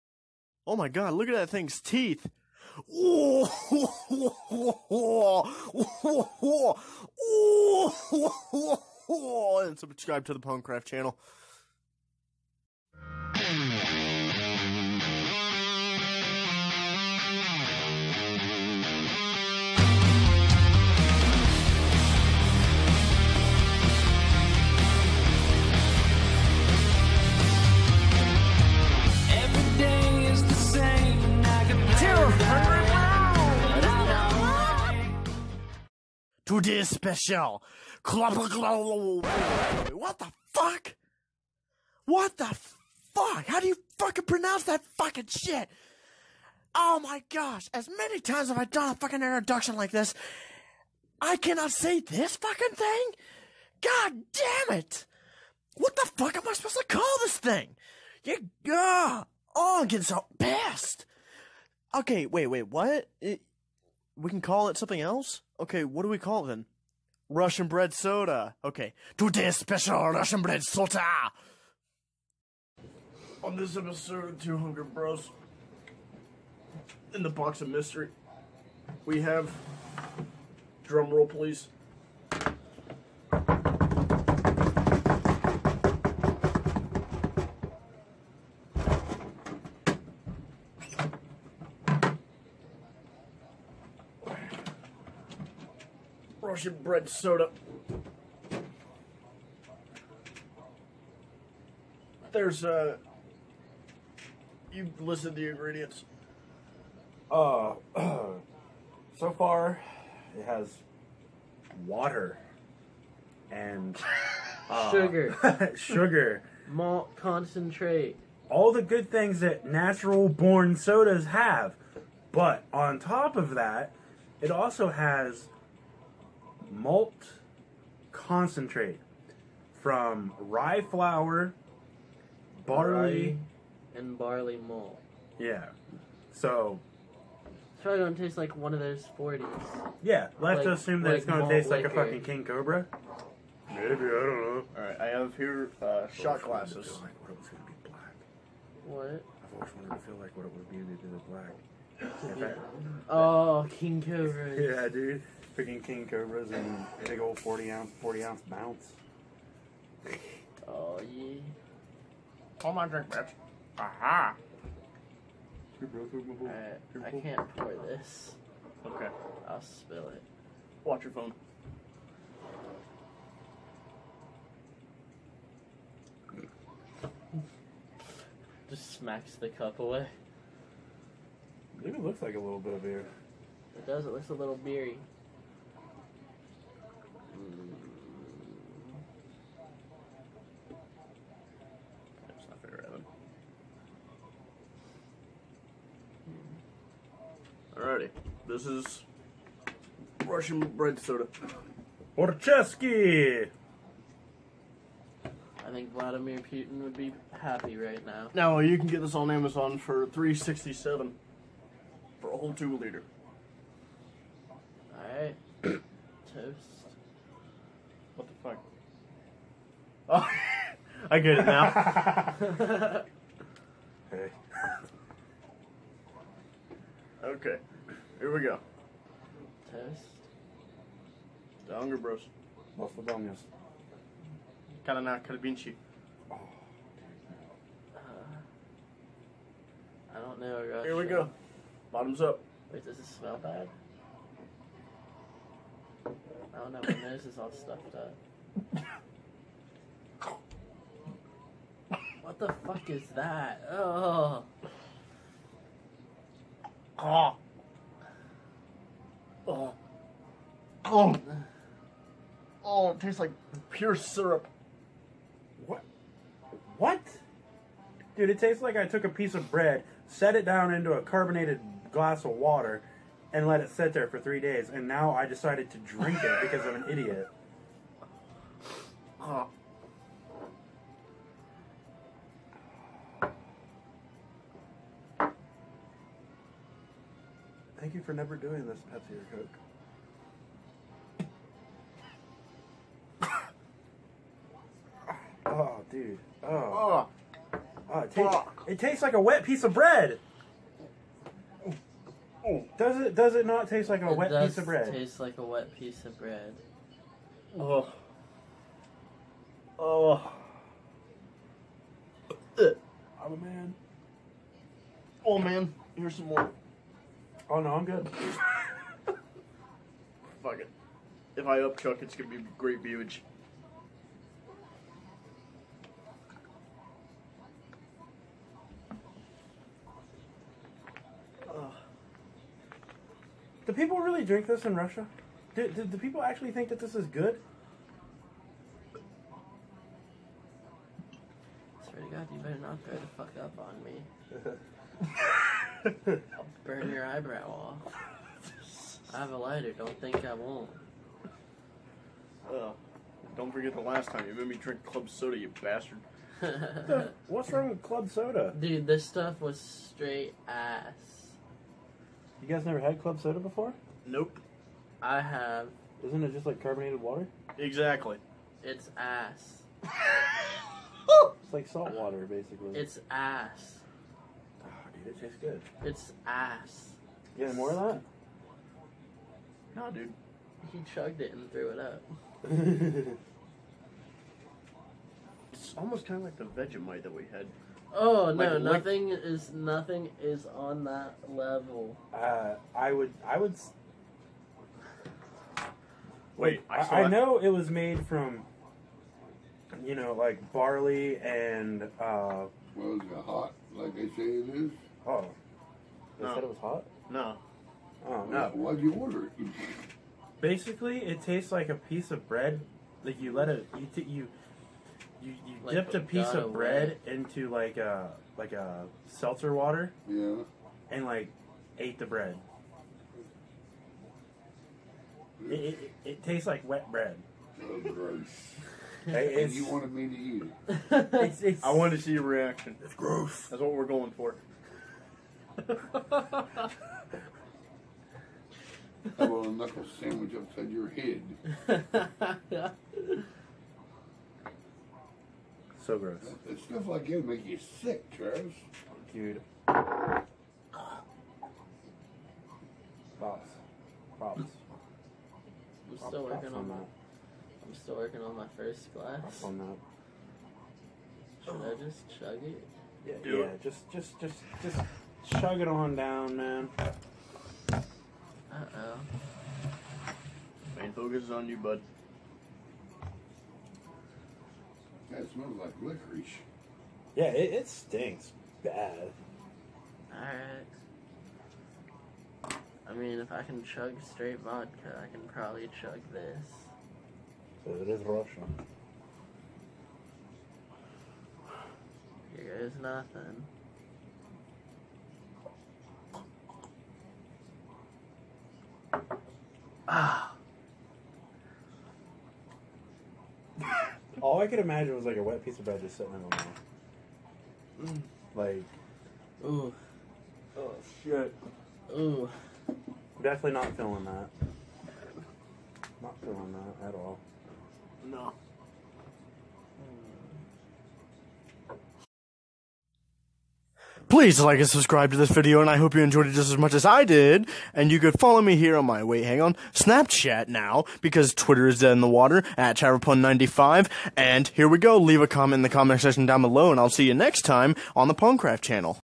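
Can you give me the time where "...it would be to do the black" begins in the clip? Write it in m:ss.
2:30.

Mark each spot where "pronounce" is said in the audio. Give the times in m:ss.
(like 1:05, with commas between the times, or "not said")
0:44.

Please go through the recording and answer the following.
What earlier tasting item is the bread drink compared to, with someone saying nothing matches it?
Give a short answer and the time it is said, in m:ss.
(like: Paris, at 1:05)
Vegemite, at 6:26.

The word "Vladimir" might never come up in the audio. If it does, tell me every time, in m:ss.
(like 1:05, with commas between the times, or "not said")
3:25.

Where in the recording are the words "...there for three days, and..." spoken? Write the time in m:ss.
4:33.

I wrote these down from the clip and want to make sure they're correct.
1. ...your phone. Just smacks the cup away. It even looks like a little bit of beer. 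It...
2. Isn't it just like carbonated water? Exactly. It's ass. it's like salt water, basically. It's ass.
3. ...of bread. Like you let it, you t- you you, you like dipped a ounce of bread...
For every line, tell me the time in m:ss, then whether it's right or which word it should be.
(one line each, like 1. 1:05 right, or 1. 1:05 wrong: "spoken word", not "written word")
1. 2:51 right
2. 6:06 right
3. 6:52 wrong: "piece", not "ounce".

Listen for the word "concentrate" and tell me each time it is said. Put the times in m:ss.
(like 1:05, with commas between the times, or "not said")
1:57, 2:08.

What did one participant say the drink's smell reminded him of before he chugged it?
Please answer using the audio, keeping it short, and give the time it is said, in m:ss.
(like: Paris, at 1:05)
licorice, at 7:55.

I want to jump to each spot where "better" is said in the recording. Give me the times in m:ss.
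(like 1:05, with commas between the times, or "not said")
5:42.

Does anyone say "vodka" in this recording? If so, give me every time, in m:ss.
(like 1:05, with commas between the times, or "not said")
8:04.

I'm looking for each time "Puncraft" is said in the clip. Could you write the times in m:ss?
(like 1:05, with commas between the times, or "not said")
0:10, 8:58.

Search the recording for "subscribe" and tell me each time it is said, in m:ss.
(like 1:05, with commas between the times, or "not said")
0:09, 8:44.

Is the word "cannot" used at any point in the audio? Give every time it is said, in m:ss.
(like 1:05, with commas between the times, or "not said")
0:51.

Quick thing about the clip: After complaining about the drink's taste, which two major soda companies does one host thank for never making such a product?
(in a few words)
Pepsi or Coke.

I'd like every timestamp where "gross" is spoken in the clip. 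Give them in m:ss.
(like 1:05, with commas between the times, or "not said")
7:07, 7:12, 7:25.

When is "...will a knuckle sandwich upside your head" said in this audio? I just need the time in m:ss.
7:19.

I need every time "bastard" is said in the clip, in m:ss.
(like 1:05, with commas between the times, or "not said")
5:55.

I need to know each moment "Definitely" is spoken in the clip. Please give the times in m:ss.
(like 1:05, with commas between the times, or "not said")
8:33.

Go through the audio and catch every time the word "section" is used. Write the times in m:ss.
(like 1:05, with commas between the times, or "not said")
8:56.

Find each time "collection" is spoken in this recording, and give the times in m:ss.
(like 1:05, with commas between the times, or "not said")
not said.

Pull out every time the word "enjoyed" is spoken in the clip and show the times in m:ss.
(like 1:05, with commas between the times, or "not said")
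8:46.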